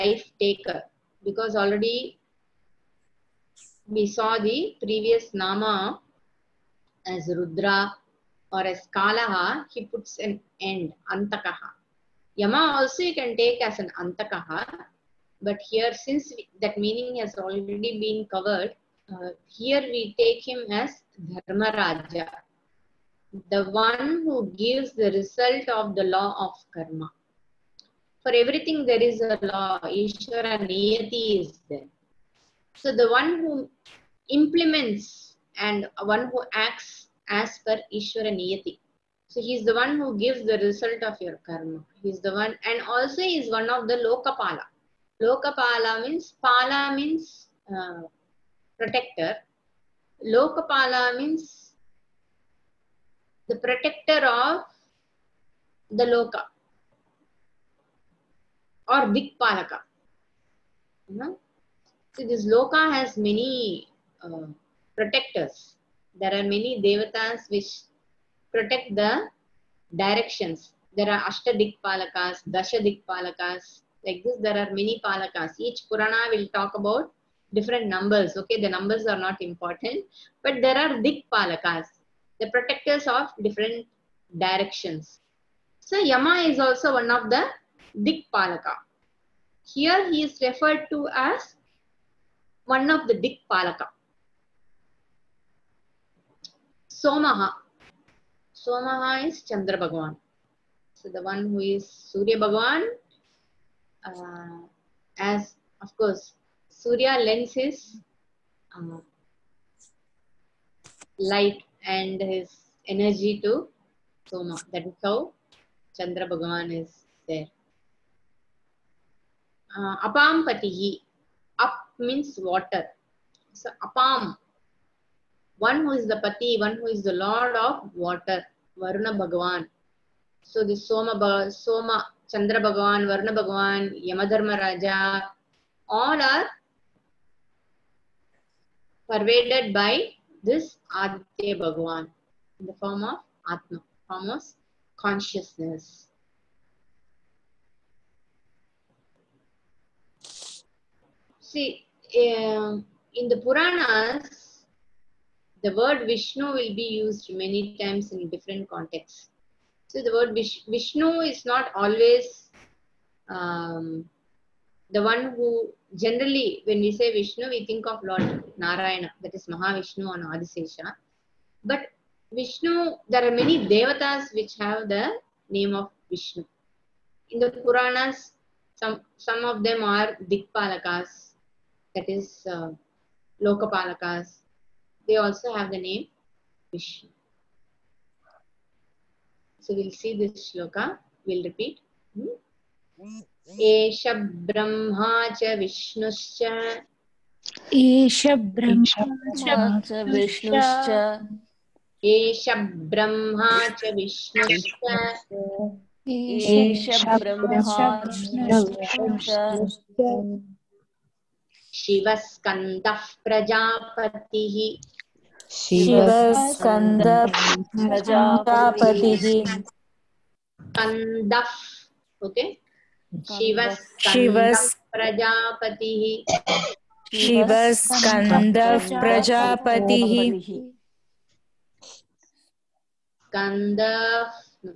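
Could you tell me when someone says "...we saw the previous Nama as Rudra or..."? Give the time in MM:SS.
00:03.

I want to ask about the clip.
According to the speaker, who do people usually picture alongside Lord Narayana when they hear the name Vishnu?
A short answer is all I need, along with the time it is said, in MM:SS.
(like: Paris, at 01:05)
Adisesha, at 02:50.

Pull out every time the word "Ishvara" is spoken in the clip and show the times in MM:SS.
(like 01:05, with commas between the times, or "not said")
00:29, 00:37.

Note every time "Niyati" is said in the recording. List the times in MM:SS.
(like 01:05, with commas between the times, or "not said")
00:30, 00:38.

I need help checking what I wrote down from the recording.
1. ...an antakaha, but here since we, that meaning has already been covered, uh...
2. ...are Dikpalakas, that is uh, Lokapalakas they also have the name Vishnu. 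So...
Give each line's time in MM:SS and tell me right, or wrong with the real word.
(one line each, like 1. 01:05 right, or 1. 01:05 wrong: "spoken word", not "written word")
1. 00:13 right
2. 02:59 right.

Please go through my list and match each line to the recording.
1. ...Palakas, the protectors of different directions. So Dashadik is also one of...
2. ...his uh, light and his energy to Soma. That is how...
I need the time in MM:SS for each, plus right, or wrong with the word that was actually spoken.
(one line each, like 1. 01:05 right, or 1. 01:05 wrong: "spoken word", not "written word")
1. 01:21 wrong: "Yama", not "Dashadik"
2. 01:47 right.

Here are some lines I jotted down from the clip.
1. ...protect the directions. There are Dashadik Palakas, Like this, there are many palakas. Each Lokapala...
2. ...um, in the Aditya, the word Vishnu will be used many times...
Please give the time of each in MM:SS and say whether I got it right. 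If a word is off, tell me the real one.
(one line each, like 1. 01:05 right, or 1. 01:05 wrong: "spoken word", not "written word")
1. 01:08 wrong: "Purana", not "Lokapala"
2. 02:32 wrong: "Puranas", not "Aditya".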